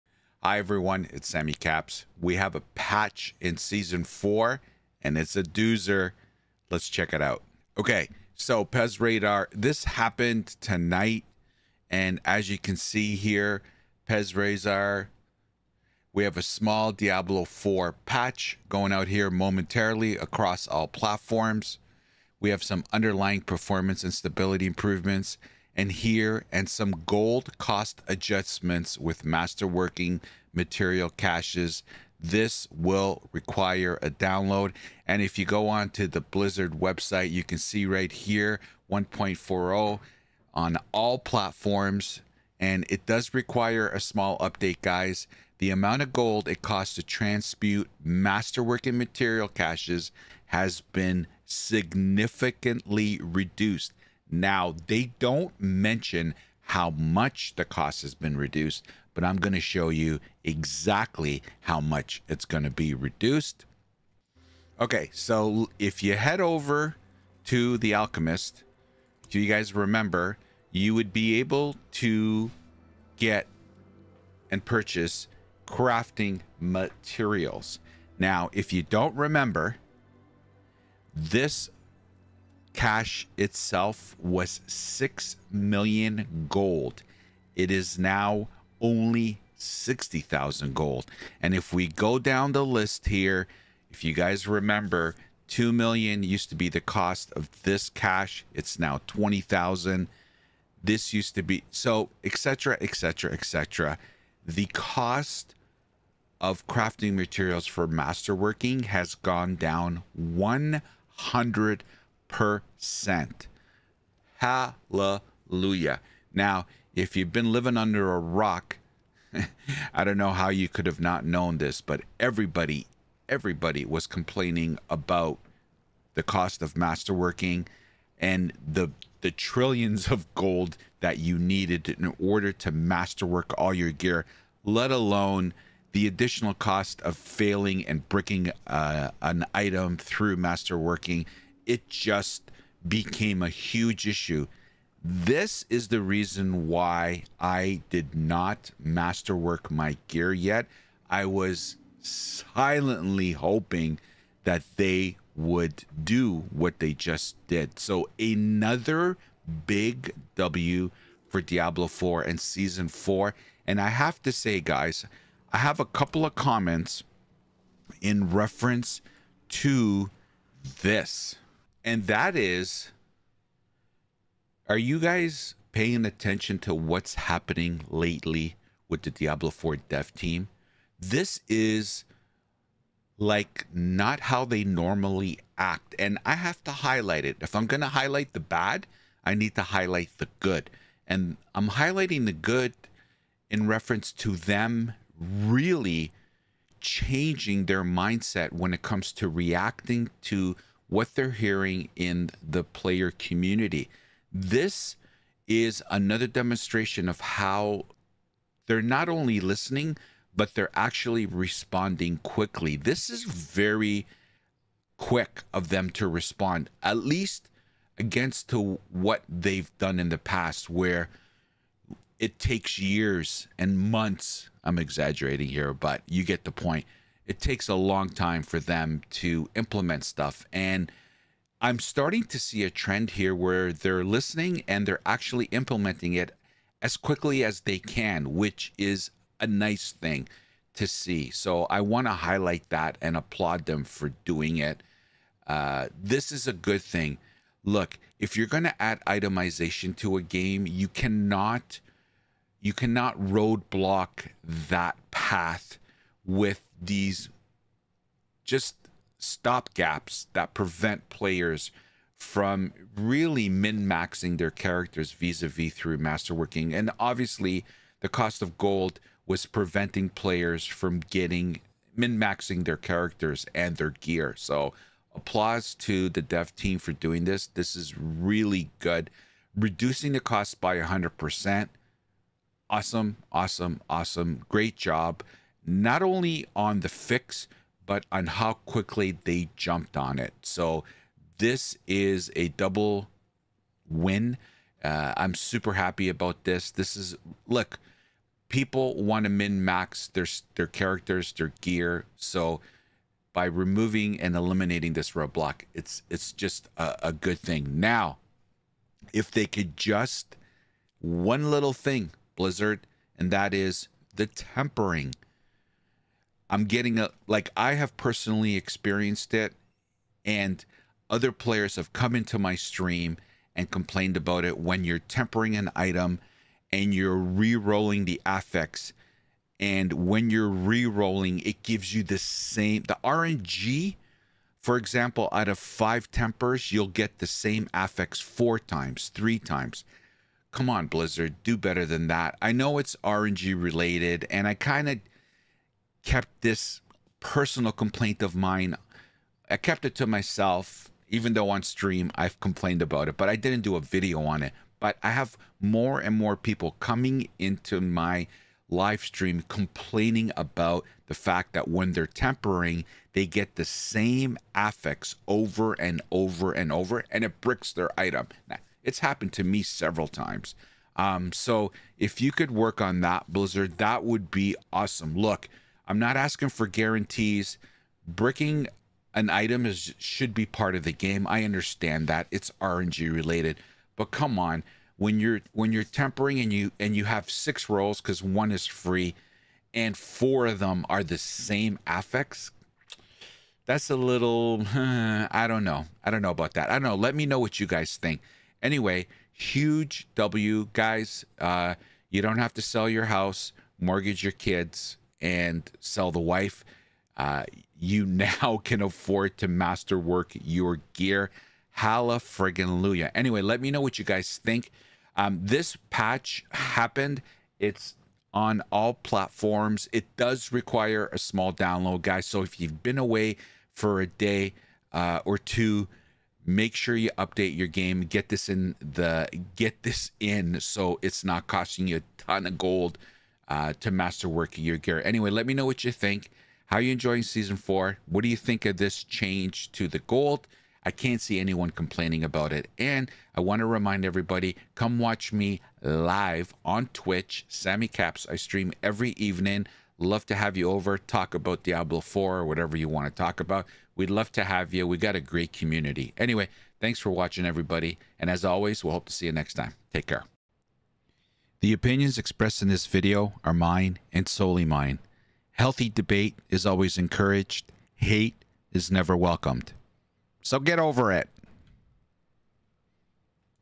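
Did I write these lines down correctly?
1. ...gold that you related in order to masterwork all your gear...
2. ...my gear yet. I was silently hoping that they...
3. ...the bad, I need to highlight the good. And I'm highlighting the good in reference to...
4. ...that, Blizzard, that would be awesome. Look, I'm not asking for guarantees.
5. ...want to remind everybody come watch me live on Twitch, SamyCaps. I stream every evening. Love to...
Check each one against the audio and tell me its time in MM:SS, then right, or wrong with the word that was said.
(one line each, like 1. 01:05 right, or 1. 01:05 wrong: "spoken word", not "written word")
1. 02:10 wrong: "needed", not "related"
2. 02:29 right
3. 03:08 right
4. 06:13 right
5. 07:23 right.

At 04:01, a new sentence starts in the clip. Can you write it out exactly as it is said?
So I want to highlight that and applaud them for doing it.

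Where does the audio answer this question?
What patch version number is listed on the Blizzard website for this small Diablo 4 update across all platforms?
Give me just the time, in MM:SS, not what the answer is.
00:38.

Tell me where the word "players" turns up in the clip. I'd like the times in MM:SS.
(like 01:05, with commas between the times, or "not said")
03:22, 04:21, 04:30, 05:21.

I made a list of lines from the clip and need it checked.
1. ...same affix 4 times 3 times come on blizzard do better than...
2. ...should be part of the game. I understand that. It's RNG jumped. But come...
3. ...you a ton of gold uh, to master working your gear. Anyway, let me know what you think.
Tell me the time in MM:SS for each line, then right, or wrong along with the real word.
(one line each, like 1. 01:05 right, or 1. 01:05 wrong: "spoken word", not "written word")
1. 05:37 right
2. 06:19 wrong: "related", not "jumped"
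3. 07:11 right.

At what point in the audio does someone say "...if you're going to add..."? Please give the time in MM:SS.
04:08.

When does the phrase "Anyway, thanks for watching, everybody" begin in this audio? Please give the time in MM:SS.
07:36.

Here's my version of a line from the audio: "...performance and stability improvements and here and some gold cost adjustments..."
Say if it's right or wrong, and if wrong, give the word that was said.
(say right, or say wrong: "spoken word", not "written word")
right.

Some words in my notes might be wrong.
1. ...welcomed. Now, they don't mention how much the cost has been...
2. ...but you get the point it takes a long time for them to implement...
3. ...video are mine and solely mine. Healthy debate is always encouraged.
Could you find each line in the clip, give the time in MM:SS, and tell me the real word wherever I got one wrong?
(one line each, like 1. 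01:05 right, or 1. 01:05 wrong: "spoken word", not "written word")
1. 00:53 wrong: "reduced", not "welcomed"
2. 03:45 right
3. 07:42 right.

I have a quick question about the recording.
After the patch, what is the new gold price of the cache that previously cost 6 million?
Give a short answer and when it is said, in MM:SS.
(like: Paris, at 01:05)
60,000 gold, at 01:29.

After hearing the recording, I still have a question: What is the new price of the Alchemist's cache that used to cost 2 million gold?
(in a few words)
20,000.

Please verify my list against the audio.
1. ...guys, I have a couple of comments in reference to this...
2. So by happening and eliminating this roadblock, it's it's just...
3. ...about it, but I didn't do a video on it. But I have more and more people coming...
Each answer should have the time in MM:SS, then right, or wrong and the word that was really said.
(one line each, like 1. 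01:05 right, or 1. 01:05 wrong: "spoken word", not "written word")
1. 02:44 right
2. 05:02 wrong: "removing", not "happening"
3. 05:52 right.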